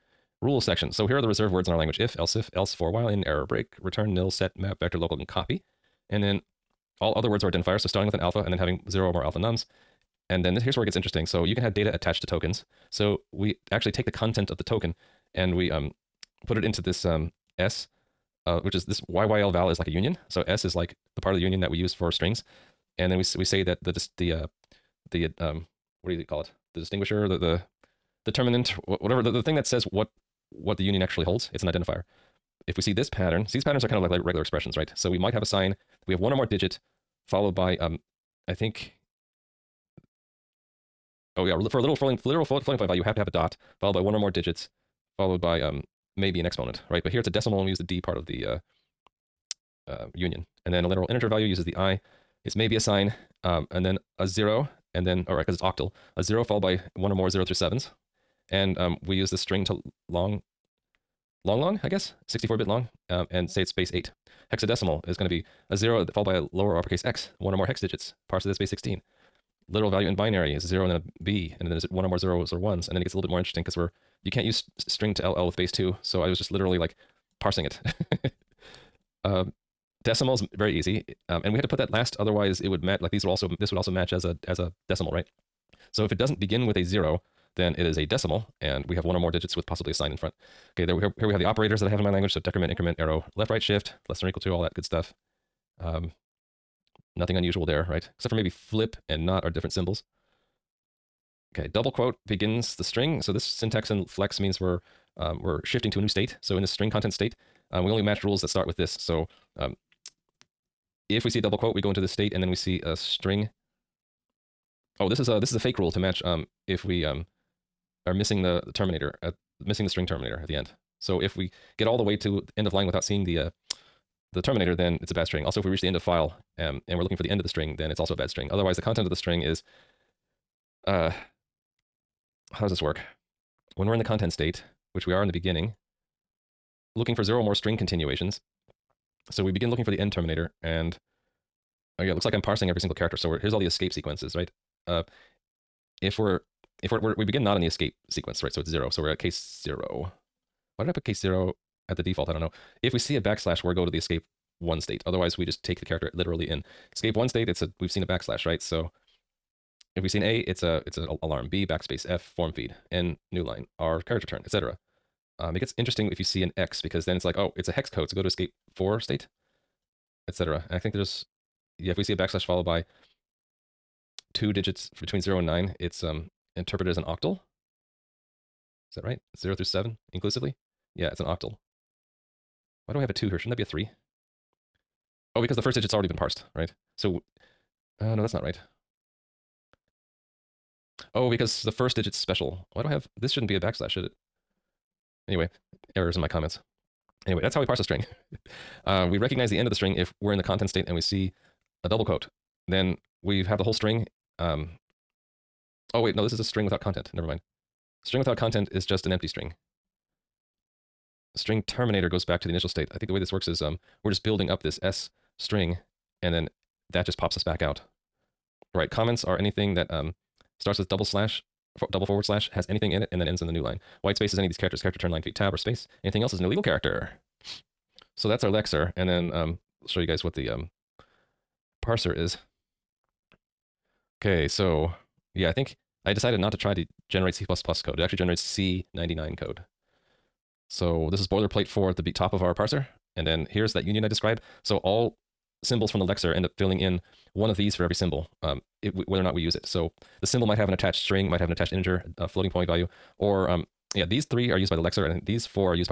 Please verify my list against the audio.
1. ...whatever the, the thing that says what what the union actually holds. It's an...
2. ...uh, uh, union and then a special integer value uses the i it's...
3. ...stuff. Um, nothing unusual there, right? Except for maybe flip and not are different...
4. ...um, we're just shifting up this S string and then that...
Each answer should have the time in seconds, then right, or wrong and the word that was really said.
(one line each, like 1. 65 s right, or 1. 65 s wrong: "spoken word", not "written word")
1. 28 s right
2. 48 s wrong: "literal", not "special"
3. 94 s right
4. 213 s wrong: "building", not "shifting".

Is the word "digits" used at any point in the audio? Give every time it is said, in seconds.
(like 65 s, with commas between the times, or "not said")
36 s, 44 s, 67 s, 89 s, 174 s, 185 s, 191 s.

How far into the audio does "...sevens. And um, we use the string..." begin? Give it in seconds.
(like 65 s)
57 s.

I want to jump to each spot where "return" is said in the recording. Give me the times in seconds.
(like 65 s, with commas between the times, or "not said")
3 s, 164 s, 224 s.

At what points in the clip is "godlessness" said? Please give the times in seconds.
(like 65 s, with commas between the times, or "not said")
not said.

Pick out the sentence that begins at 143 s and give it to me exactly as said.
So here's all the escape sequences, right?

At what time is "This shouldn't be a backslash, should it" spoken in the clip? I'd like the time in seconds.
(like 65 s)
193 s.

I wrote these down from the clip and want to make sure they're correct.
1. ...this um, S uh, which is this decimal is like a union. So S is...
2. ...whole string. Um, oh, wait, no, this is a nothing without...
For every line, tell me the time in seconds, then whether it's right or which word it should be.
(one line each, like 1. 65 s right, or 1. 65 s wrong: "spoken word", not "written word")
1. 16 s wrong: "yylval", not "decimal"
2. 203 s wrong: "string", not "nothing".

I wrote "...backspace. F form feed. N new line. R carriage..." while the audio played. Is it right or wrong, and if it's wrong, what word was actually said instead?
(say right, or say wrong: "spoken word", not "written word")
right.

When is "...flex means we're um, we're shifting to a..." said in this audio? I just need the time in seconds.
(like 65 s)
104 s.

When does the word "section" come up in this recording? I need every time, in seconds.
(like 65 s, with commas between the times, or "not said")
0 s.